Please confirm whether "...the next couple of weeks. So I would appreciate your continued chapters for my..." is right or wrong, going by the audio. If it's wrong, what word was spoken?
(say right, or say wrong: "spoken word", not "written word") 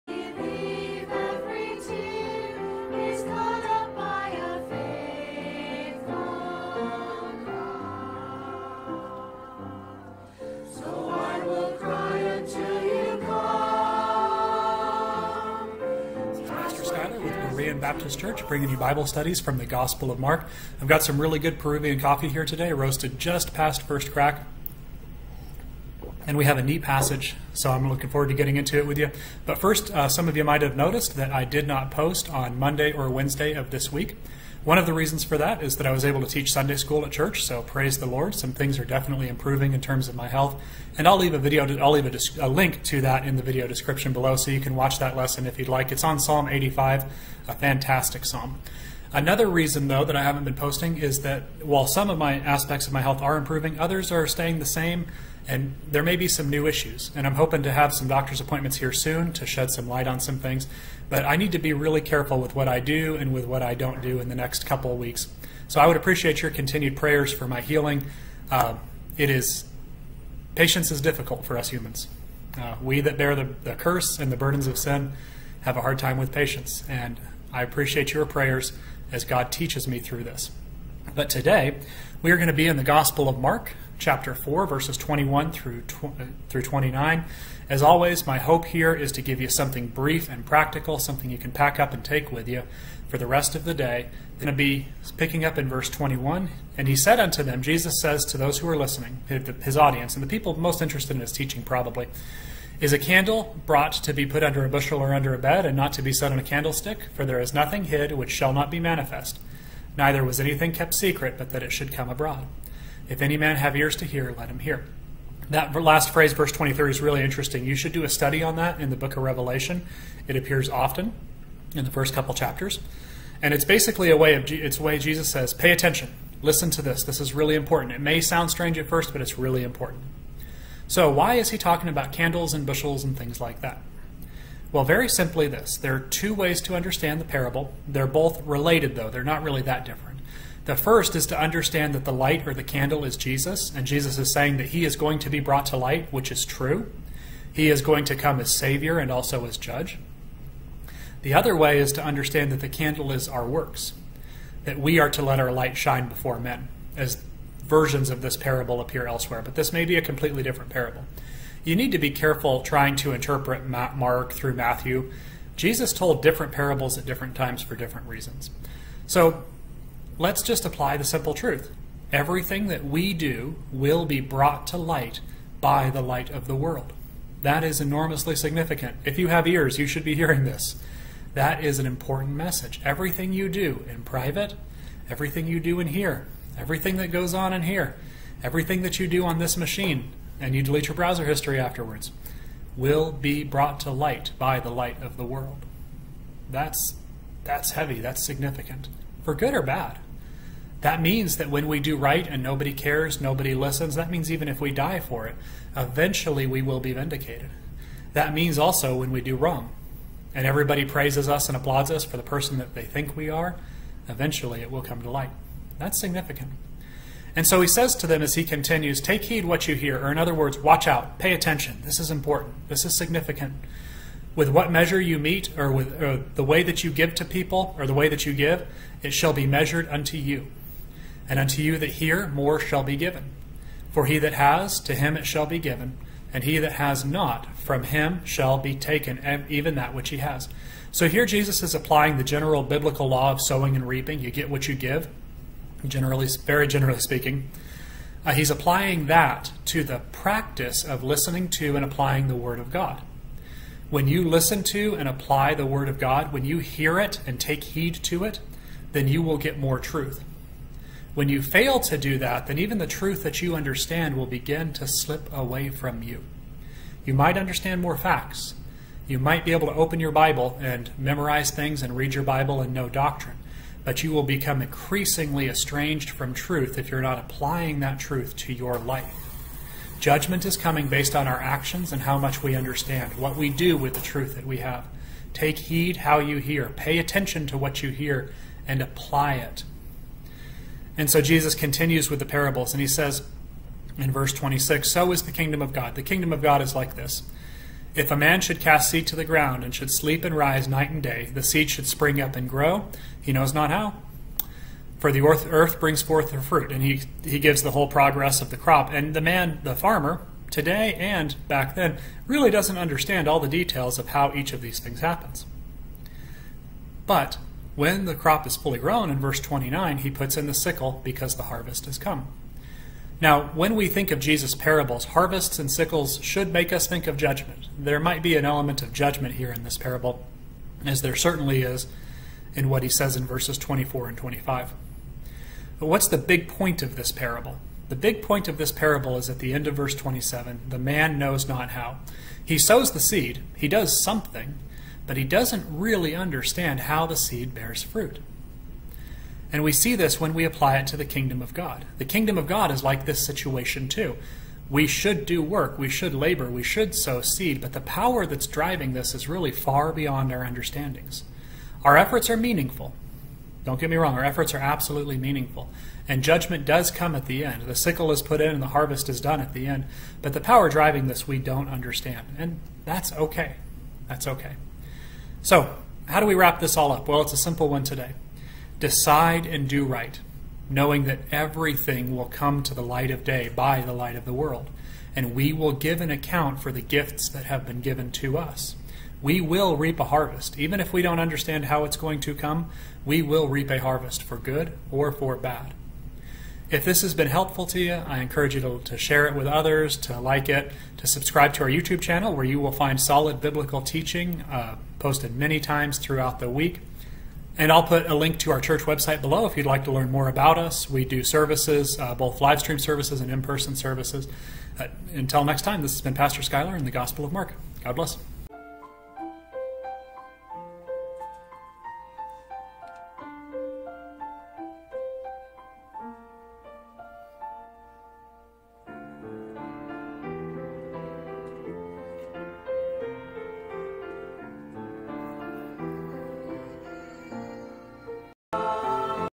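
wrong: "prayers", not "chapters".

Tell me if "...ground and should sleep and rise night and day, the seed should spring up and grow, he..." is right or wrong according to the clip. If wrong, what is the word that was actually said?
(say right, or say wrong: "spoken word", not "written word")
right.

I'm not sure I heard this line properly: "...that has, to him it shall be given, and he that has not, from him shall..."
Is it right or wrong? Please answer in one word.
right.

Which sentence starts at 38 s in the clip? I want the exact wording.
Some things are definitely improving in terms of my health, and I'll leave a video.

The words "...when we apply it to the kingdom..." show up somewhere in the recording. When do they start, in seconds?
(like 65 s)
350 s.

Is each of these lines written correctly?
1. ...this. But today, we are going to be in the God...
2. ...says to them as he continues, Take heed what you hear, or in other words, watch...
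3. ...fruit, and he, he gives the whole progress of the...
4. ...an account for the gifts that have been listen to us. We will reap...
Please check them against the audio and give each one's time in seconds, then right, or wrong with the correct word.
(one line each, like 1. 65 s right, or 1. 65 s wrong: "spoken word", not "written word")
1. 80 s wrong: "Gospel", not "God"
2. 217 s right
3. 306 s right
4. 386 s wrong: "given", not "listen".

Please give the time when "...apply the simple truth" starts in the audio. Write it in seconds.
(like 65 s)
170 s.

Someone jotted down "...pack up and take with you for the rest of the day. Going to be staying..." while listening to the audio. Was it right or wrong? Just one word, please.
wrong.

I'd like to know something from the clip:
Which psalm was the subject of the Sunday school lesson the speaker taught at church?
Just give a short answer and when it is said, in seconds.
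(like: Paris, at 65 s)
Psalm 85, at 46 s.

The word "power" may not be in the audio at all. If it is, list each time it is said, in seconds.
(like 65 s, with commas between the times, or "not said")
357 s, 370 s.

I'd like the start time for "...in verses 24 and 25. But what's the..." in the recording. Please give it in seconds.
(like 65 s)
333 s.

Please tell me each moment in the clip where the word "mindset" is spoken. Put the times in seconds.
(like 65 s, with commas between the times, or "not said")
not said.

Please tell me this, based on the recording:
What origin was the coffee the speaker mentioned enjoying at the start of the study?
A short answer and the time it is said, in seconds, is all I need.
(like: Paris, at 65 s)
Peruvian, at 21 s.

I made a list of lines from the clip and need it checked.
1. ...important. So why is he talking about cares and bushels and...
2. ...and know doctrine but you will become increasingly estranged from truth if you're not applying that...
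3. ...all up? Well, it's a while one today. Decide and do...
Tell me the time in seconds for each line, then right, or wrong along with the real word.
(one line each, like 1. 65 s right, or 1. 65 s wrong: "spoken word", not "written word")
1. 129 s wrong: "candles", not "cares"
2. 272 s right
3. 376 s wrong: "simple", not "while".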